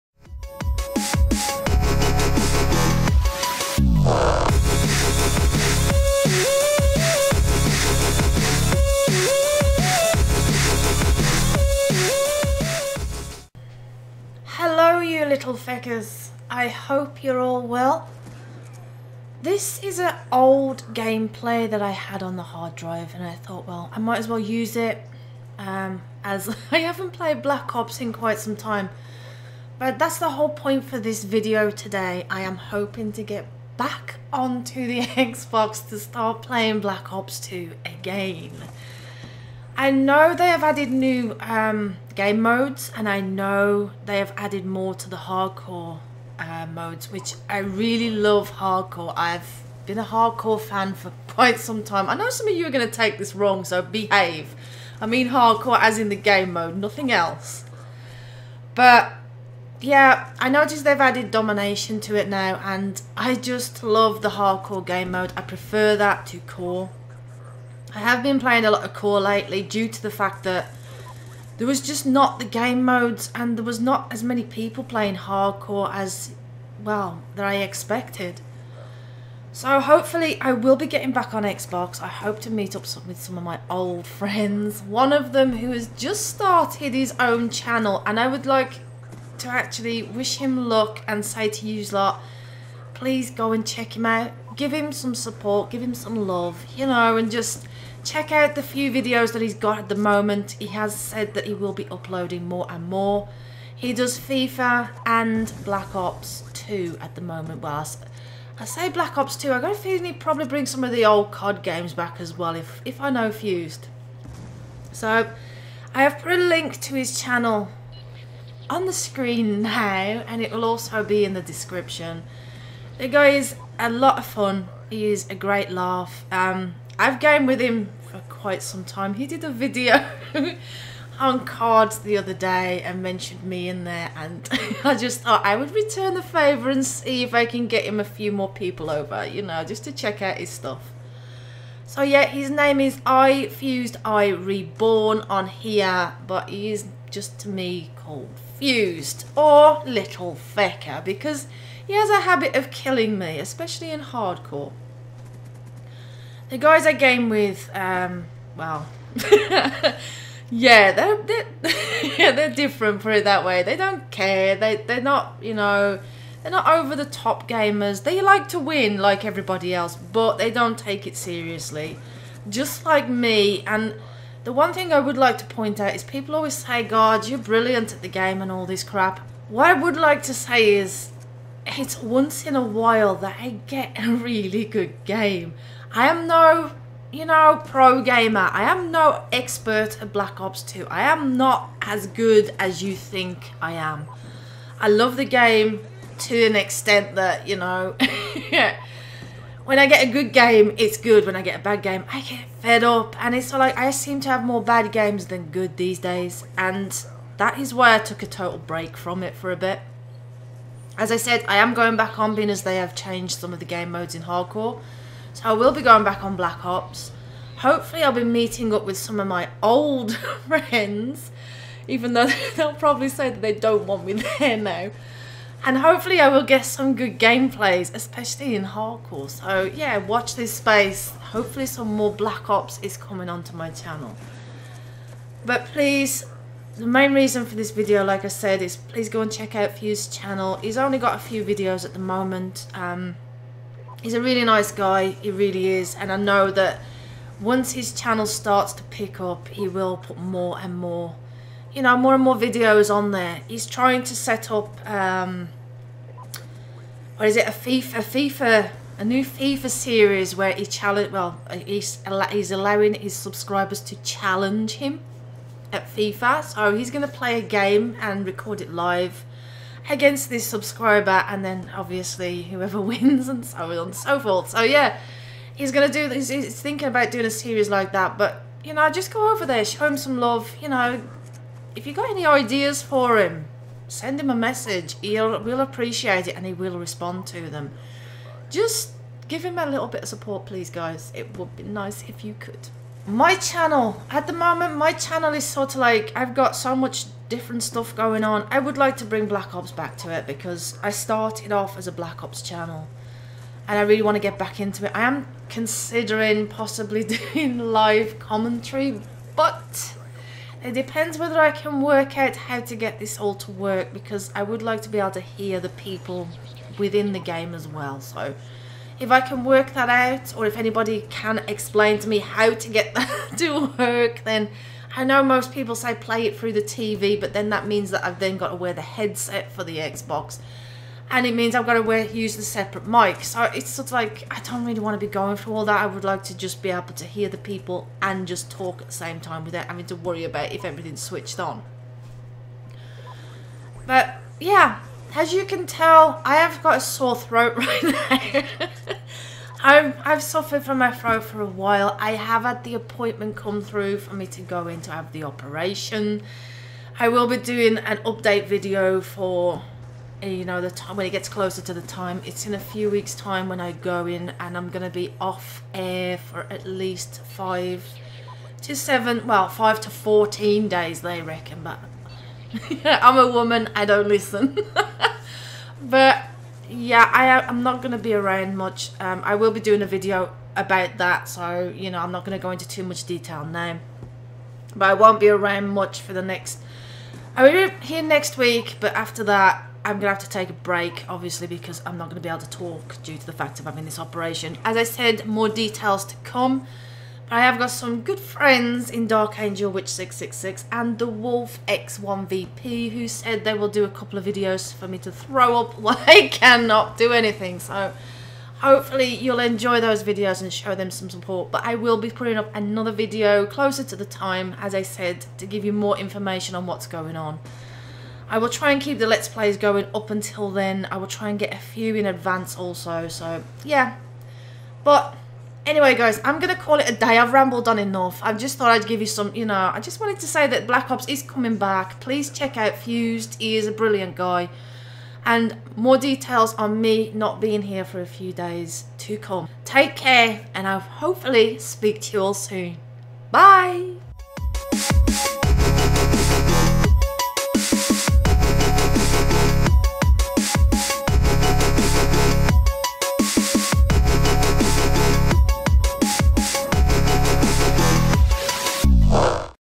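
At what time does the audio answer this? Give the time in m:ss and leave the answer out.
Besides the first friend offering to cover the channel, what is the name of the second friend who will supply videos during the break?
6:40.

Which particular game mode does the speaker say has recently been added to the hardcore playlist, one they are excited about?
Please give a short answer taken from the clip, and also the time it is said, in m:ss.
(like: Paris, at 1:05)
Domination, at 1:01.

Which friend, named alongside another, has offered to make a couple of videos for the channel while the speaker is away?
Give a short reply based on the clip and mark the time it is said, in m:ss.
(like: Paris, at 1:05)
Dark Angel Witch 666, at 6:39.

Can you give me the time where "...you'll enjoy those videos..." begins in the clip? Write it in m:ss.
6:49.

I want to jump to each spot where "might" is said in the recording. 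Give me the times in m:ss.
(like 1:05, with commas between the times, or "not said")
0:23.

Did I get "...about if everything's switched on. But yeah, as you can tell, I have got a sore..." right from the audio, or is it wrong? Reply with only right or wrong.
right.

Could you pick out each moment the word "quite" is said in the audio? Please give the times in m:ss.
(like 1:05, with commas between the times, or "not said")
0:28, 0:51, 2:08.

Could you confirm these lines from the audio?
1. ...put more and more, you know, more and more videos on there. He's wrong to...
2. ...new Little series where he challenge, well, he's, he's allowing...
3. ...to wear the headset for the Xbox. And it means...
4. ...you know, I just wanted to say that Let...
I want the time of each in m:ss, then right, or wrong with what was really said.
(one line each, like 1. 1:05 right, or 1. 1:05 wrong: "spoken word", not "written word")
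1. 4:09 wrong: "trying", not "wrong"
2. 4:19 wrong: "FIFA", not "Little"
3. 5:28 right
4. 7:09 wrong: "Black", not "Let".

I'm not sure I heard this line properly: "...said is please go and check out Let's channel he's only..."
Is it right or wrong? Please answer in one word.
wrong.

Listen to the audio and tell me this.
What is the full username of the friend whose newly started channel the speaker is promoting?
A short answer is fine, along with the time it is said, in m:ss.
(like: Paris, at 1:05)
I Fused I Reborn, at 2:23.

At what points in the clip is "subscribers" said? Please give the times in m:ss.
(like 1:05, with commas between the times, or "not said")
4:23, 4:30.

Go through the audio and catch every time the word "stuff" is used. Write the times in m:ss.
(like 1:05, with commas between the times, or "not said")
2:20, 4:57.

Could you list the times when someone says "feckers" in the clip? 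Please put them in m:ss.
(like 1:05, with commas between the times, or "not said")
0:15, 2:30.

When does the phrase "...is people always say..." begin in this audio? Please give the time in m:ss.
2:55.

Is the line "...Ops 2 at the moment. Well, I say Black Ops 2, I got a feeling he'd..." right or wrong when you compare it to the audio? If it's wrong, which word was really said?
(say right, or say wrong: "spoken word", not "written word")
right.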